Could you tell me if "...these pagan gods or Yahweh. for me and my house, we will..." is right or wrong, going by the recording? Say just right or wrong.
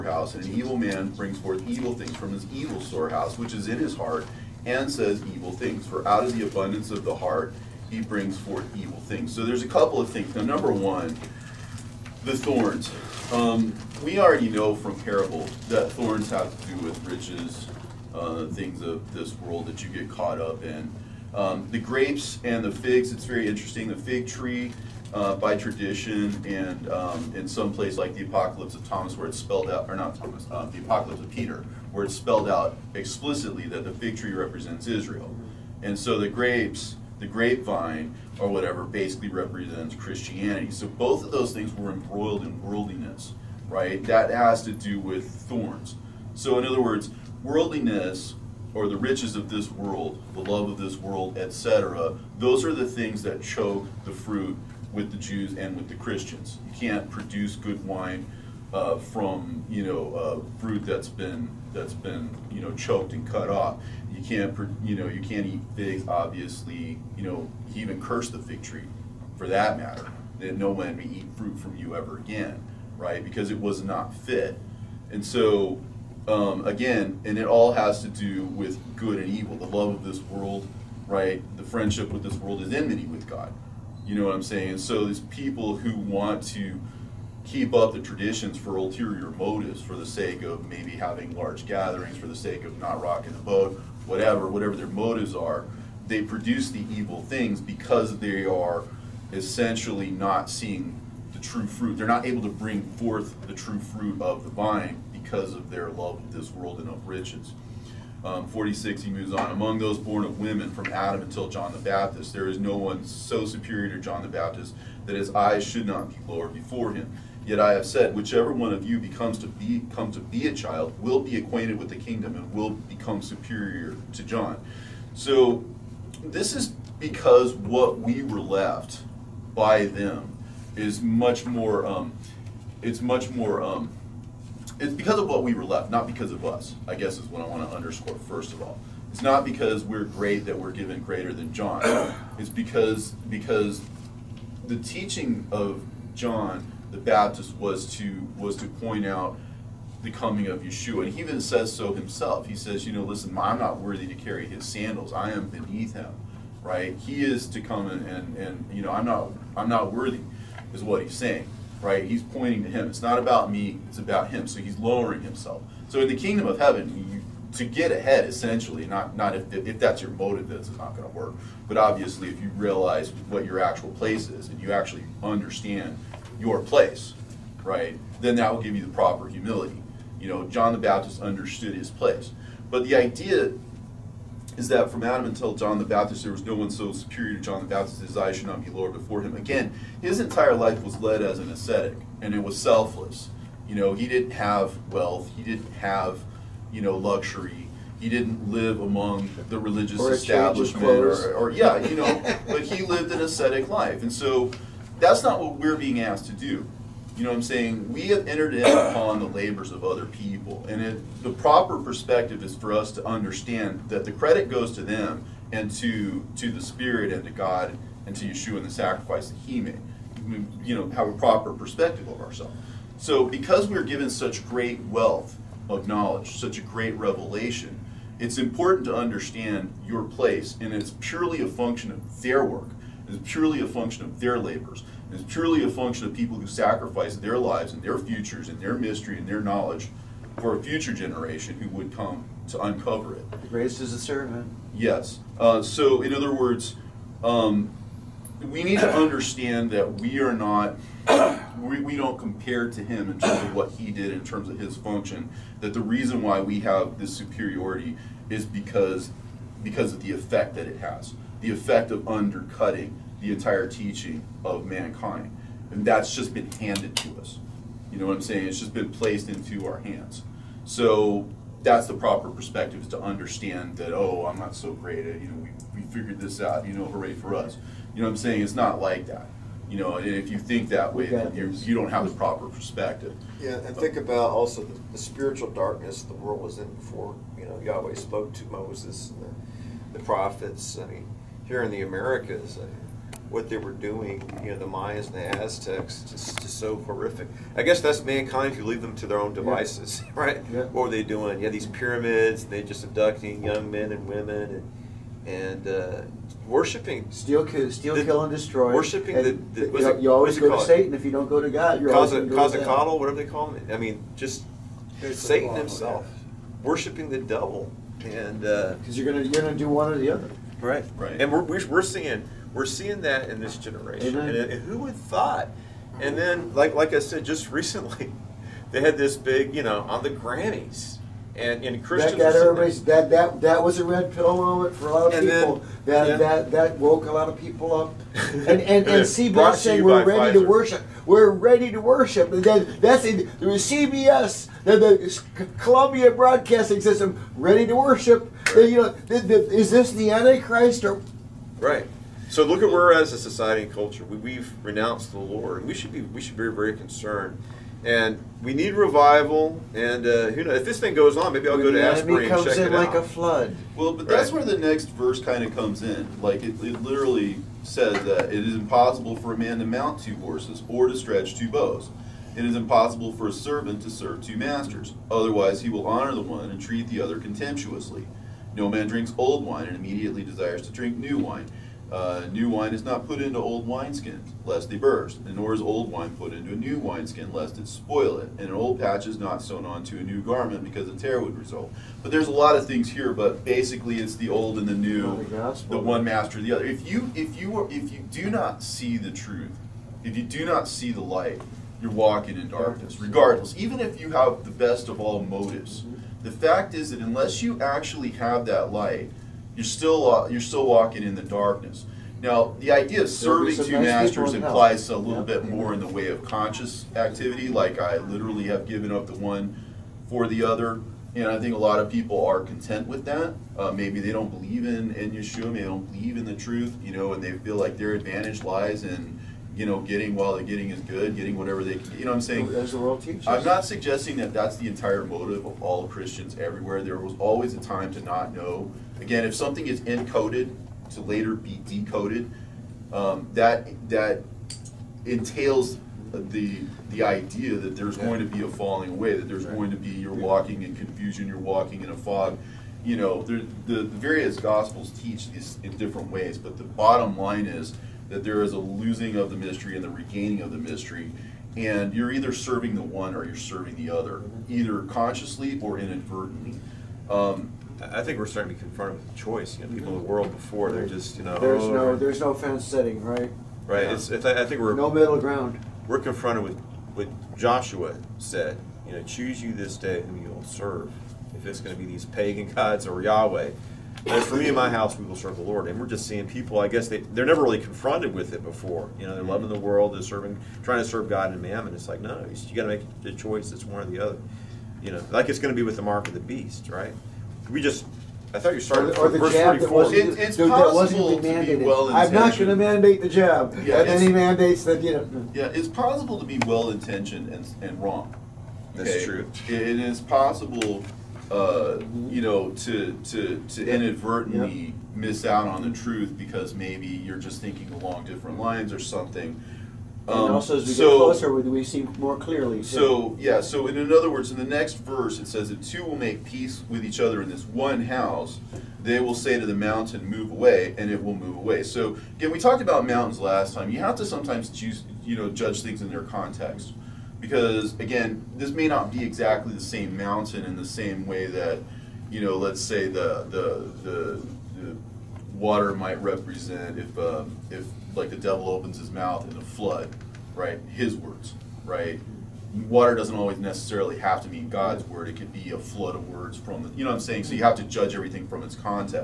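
right.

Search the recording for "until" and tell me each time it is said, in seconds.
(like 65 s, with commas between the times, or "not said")
111 s, 185 s.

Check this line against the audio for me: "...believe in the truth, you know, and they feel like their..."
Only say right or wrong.
right.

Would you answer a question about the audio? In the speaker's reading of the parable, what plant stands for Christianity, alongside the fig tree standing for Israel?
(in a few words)
grapevine.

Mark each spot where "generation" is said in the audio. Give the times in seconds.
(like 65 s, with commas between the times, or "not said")
240 s, 323 s.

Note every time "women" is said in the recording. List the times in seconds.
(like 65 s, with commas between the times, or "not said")
110 s, 304 s.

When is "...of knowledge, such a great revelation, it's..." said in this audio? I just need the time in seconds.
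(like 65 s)
225 s.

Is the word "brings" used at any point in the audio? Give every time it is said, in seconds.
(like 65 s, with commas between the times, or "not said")
1 s, 8 s, 102 s.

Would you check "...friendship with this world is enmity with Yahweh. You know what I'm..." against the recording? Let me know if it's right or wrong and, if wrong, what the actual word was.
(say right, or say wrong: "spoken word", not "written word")
wrong: "God", not "Yahweh".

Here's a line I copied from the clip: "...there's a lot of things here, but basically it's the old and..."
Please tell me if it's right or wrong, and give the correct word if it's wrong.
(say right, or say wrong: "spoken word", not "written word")
right.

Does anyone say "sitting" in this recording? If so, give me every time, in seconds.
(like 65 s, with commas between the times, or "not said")
472 s.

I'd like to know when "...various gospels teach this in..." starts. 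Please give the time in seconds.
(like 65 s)
453 s.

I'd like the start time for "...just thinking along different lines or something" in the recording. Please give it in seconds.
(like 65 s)
517 s.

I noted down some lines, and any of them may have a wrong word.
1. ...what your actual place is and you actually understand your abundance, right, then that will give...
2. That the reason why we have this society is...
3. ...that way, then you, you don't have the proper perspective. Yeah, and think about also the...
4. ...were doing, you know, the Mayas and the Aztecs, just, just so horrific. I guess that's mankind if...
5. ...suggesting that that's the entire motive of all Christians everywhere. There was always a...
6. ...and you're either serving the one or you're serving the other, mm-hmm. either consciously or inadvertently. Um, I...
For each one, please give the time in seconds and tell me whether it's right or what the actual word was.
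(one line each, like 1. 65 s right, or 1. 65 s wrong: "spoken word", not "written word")
1. 173 s wrong: "place", not "abundance"
2. 255 s wrong: "superiority", not "society"
3. 280 s right
4. 293 s right
5. 433 s right
6. 461 s right.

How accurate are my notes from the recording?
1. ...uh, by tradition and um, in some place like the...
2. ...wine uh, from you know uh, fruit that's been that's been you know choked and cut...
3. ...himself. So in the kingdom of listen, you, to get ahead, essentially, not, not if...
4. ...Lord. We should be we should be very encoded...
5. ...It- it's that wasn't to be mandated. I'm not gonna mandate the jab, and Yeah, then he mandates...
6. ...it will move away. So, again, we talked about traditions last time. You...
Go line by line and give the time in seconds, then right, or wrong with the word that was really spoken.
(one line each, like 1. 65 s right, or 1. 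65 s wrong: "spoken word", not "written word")
1. 25 s right
2. 57 s right
3. 165 s wrong: "heaven", not "listen"
4. 355 s wrong: "concerned", not "encoded"
5. 499 s right
6. 530 s wrong: "mountains", not "traditions".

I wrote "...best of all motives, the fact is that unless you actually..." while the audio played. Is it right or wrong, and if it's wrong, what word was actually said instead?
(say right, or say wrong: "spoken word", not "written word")
right.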